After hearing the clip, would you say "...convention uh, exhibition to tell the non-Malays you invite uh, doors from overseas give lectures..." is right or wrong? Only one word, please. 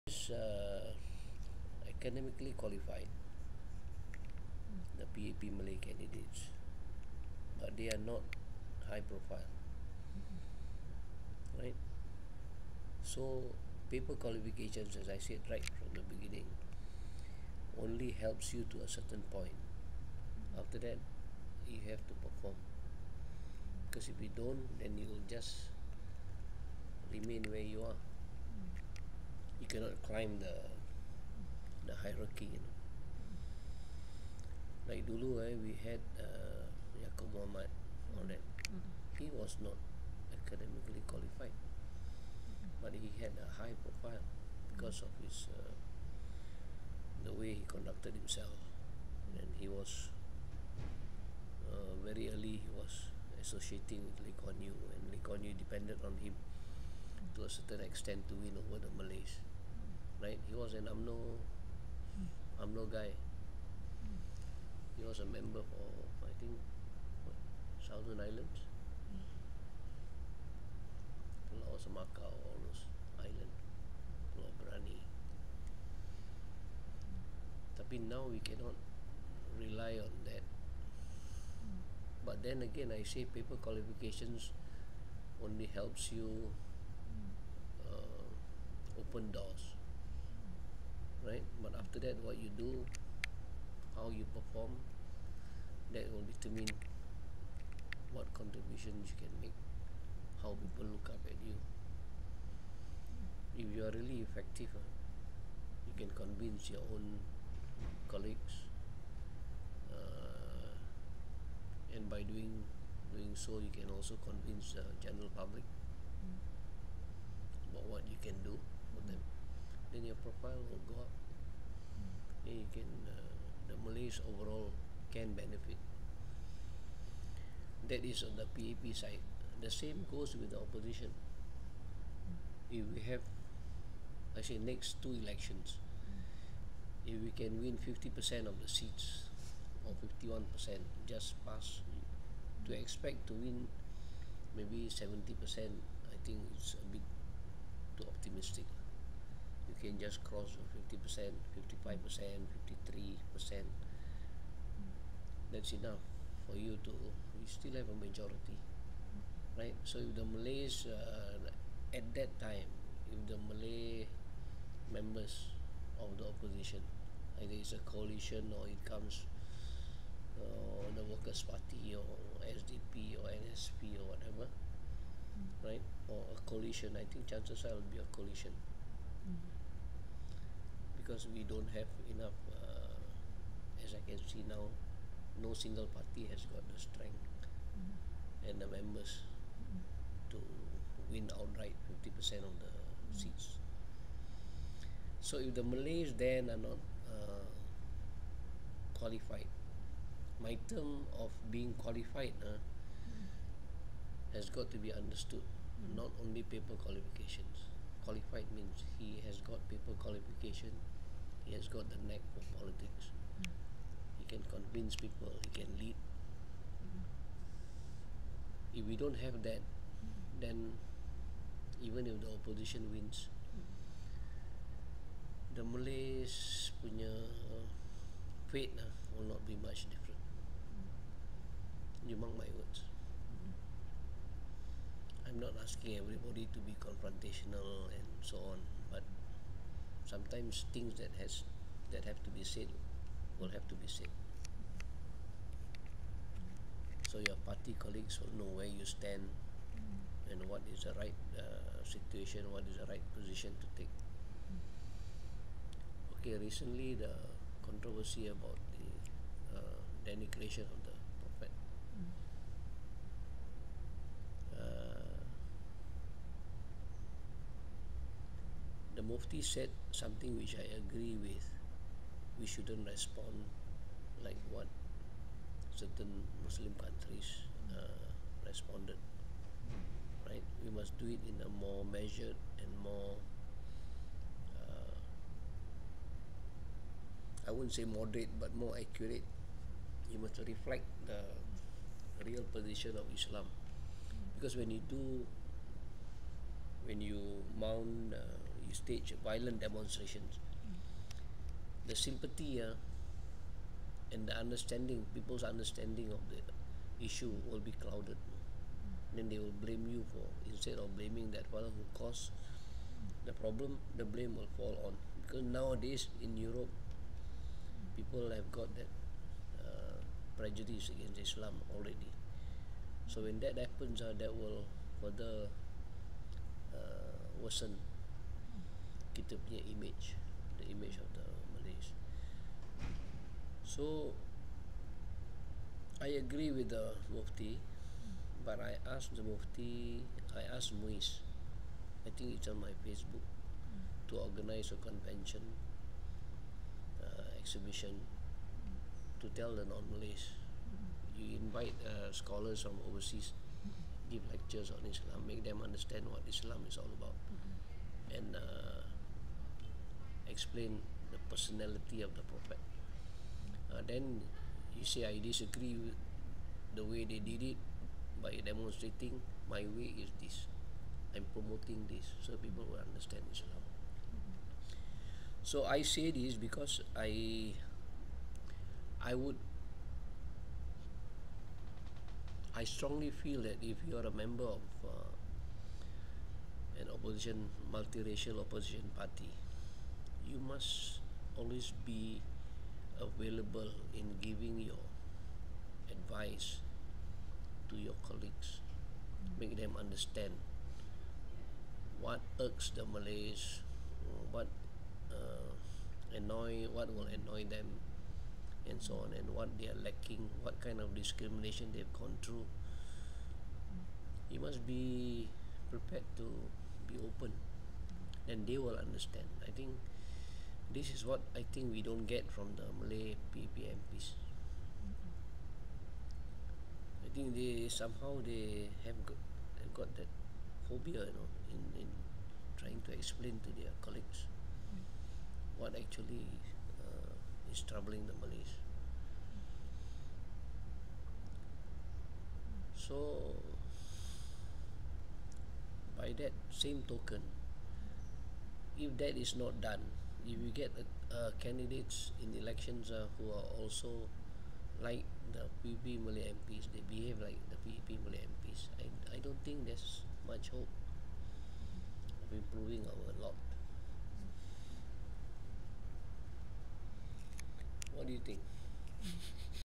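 wrong.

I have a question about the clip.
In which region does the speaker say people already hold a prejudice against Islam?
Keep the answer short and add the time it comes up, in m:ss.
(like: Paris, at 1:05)
Europe, at 5:16.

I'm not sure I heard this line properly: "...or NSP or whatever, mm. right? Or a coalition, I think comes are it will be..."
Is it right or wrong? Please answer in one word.
wrong.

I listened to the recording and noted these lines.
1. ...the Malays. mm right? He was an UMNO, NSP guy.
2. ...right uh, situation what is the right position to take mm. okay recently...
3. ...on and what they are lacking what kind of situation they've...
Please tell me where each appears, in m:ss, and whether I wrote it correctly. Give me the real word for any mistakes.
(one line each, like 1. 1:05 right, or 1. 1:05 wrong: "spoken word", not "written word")
1. 0:58 wrong: "UMNO", not "NSP"
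2. 4:10 right
3. 6:49 wrong: "discrimination", not "situation".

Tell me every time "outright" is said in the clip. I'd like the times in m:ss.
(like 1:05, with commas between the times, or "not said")
3:11.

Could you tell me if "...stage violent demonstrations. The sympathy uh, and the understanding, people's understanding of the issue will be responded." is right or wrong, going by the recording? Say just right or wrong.
wrong.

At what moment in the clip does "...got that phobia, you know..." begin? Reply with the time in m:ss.
7:09.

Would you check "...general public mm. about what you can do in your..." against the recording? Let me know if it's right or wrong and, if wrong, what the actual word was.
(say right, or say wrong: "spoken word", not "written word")
right.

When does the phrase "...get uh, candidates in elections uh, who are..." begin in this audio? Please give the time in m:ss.
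7:30.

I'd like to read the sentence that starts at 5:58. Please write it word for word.
and uh, explain the personality of the prophet.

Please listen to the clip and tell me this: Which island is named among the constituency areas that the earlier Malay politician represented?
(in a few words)
Pulau Brani.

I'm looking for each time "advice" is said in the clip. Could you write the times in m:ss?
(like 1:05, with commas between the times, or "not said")
6:35.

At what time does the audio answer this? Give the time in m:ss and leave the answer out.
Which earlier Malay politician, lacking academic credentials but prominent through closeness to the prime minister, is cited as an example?
0:36.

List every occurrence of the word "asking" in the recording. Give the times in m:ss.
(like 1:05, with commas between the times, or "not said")
3:55.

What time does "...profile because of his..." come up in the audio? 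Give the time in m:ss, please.
0:43.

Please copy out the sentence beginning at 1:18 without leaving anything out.
now we cannot rely on that.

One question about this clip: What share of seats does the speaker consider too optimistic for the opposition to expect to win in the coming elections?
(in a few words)
70%.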